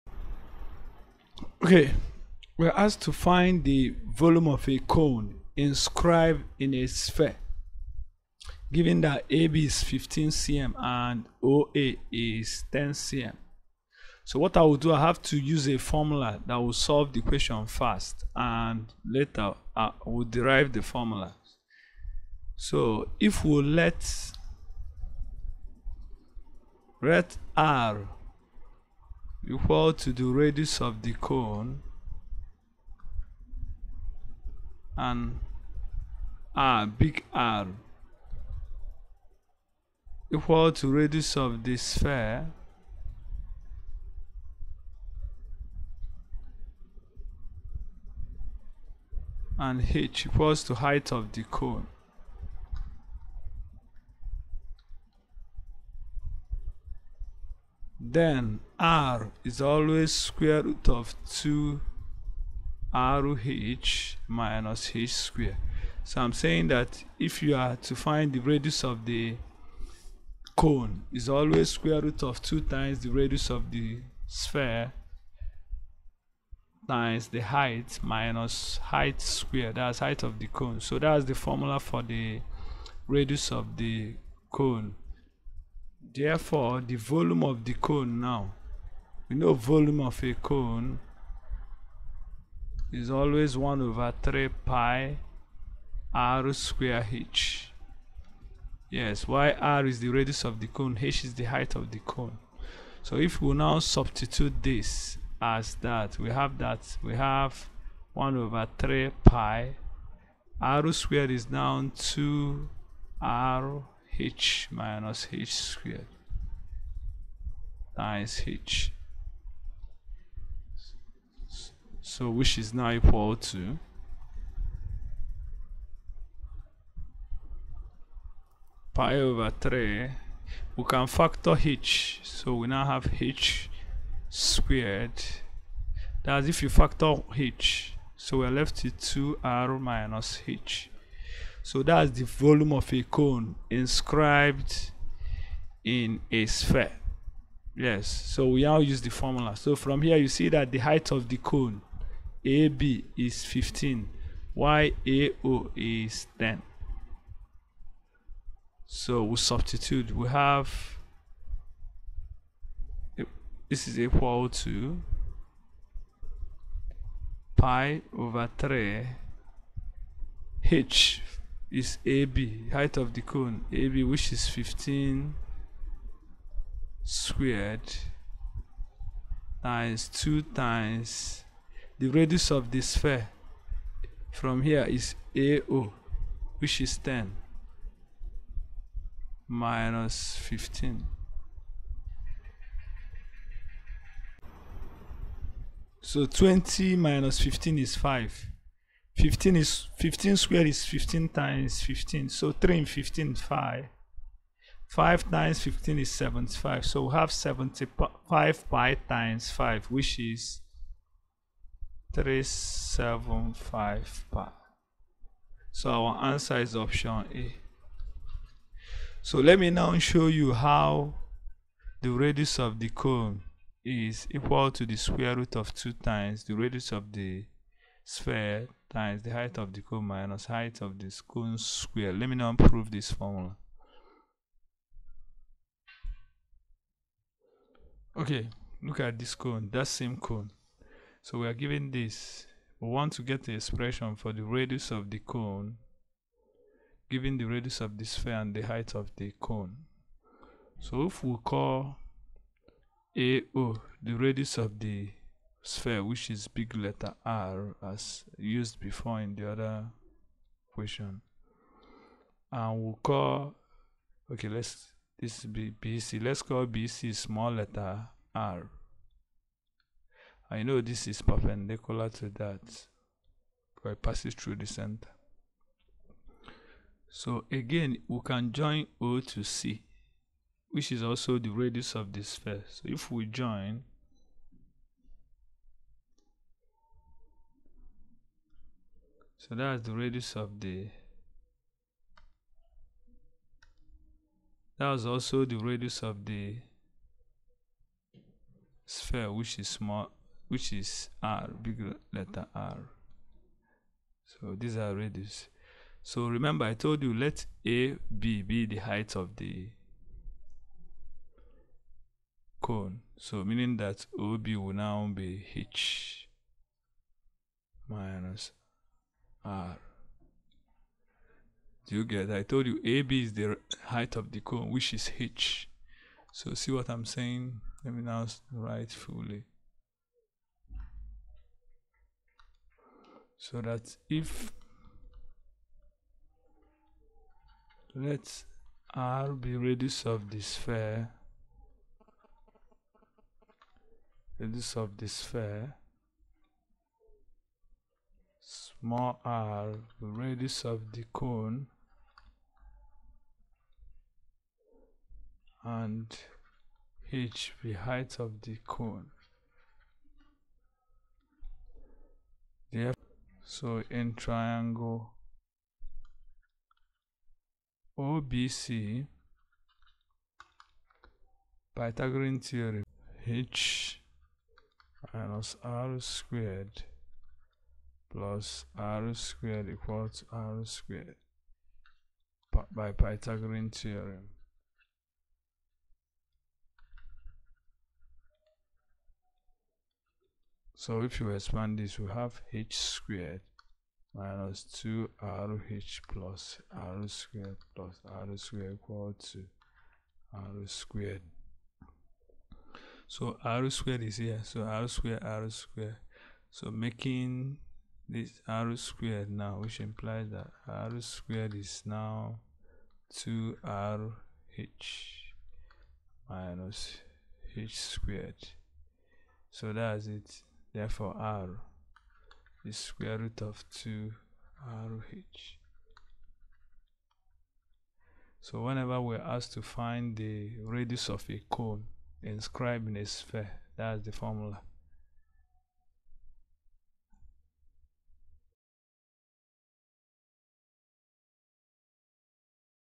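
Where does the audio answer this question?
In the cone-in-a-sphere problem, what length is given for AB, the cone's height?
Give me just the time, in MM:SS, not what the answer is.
00:09.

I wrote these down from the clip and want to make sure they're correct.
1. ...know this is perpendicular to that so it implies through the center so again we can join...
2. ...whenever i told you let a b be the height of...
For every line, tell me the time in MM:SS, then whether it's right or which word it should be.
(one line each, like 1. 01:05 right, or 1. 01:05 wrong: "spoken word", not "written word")
1. 04:30 wrong: "passes", not "implies"
2. 05:06 wrong: "remember", not "whenever".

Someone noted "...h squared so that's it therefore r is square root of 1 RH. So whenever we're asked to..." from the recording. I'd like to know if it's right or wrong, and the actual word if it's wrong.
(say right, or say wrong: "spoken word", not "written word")
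wrong: "2", not "1".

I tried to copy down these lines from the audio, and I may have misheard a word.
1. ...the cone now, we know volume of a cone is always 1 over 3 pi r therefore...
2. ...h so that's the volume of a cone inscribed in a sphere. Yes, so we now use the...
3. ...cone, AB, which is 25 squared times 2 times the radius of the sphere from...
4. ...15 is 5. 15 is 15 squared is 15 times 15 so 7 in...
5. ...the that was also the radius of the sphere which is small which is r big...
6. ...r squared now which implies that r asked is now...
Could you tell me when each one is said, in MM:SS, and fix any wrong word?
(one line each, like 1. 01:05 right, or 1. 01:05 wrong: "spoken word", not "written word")
1. 01:27 wrong: "square", not "therefore"
2. 02:20 right
3. 02:53 wrong: "15", not "25"
4. 03:17 wrong: "3", not "7"
5. 04:50 right
6. 06:48 wrong: "squared", not "asked".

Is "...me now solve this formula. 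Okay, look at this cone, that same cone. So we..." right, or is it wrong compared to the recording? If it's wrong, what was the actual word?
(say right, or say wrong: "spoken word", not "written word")
wrong: "prove", not "solve".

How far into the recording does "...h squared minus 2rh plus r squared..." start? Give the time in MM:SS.
06:32.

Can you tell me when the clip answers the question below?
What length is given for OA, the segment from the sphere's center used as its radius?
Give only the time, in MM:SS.
00:11.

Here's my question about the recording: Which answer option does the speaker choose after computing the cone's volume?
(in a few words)
Option A.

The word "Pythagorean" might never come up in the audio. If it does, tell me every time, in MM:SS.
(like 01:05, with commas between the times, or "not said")
06:11, 06:22.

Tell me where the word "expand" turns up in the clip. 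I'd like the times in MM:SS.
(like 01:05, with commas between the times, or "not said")
06:31.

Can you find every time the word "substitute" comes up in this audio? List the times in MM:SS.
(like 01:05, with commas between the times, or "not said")
01:43, 02:39.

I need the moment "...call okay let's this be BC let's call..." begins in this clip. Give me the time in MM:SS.
04:23.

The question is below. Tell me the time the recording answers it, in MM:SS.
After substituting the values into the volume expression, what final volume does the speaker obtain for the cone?
03:32.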